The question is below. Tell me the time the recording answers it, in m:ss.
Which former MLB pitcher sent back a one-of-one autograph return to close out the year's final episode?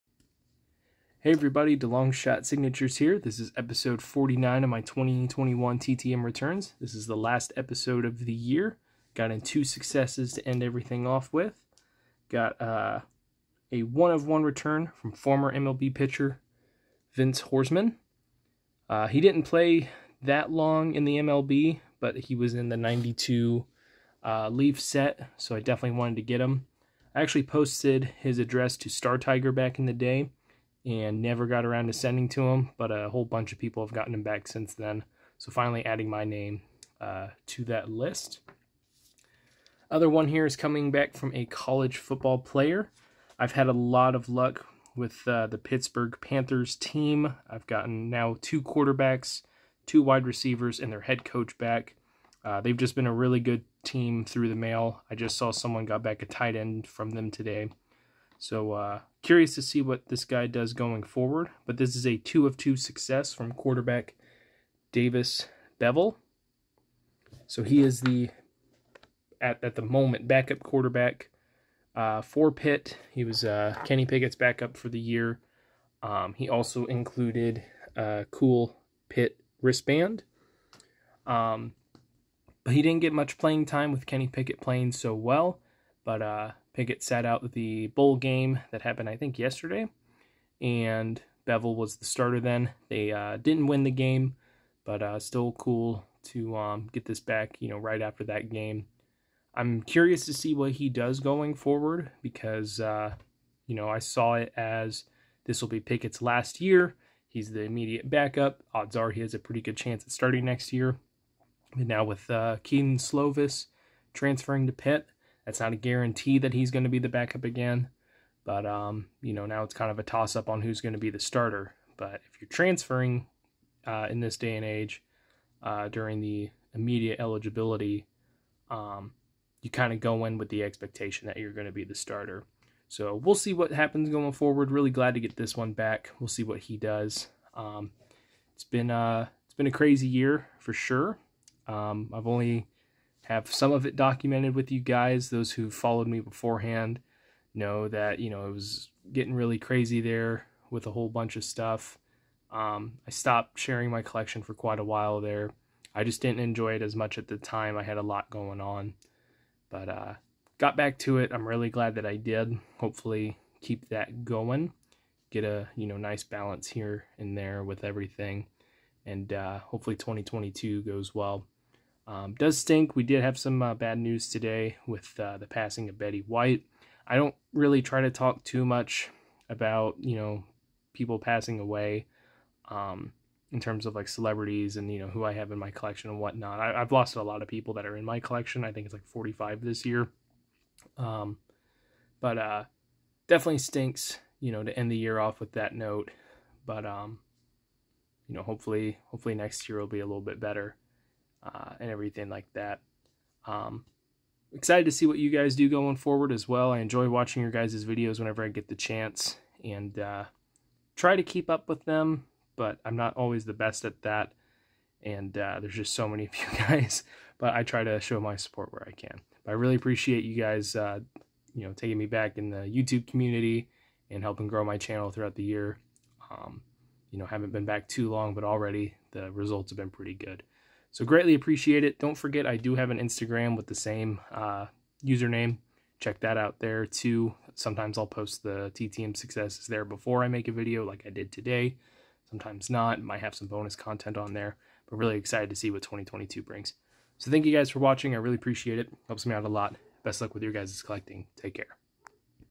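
0:17.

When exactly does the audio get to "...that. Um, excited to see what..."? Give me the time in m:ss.
3:22.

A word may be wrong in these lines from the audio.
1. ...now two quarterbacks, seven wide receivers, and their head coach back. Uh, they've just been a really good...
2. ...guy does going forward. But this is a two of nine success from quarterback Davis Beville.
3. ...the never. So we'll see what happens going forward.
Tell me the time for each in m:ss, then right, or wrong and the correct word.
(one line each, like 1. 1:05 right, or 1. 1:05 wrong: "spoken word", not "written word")
1. 0:48 wrong: "two", not "seven"
2. 1:00 wrong: "two", not "nine"
3. 2:11 wrong: "starter", not "never".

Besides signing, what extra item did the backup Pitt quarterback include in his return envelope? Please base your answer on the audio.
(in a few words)
Pitt wristband.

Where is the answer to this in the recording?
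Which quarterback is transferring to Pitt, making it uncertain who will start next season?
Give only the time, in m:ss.
1:52.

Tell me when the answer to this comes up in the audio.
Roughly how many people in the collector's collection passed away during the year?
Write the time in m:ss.
3:09.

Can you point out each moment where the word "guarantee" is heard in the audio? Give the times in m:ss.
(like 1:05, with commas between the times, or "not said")
1:55.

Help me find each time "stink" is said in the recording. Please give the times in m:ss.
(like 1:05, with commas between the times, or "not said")
2:52, 3:13.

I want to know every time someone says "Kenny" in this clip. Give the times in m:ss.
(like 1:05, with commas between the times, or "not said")
1:13, 1:24.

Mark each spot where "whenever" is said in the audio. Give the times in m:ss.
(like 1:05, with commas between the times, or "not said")
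3:28.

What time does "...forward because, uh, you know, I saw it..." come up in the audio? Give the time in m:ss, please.
1:41.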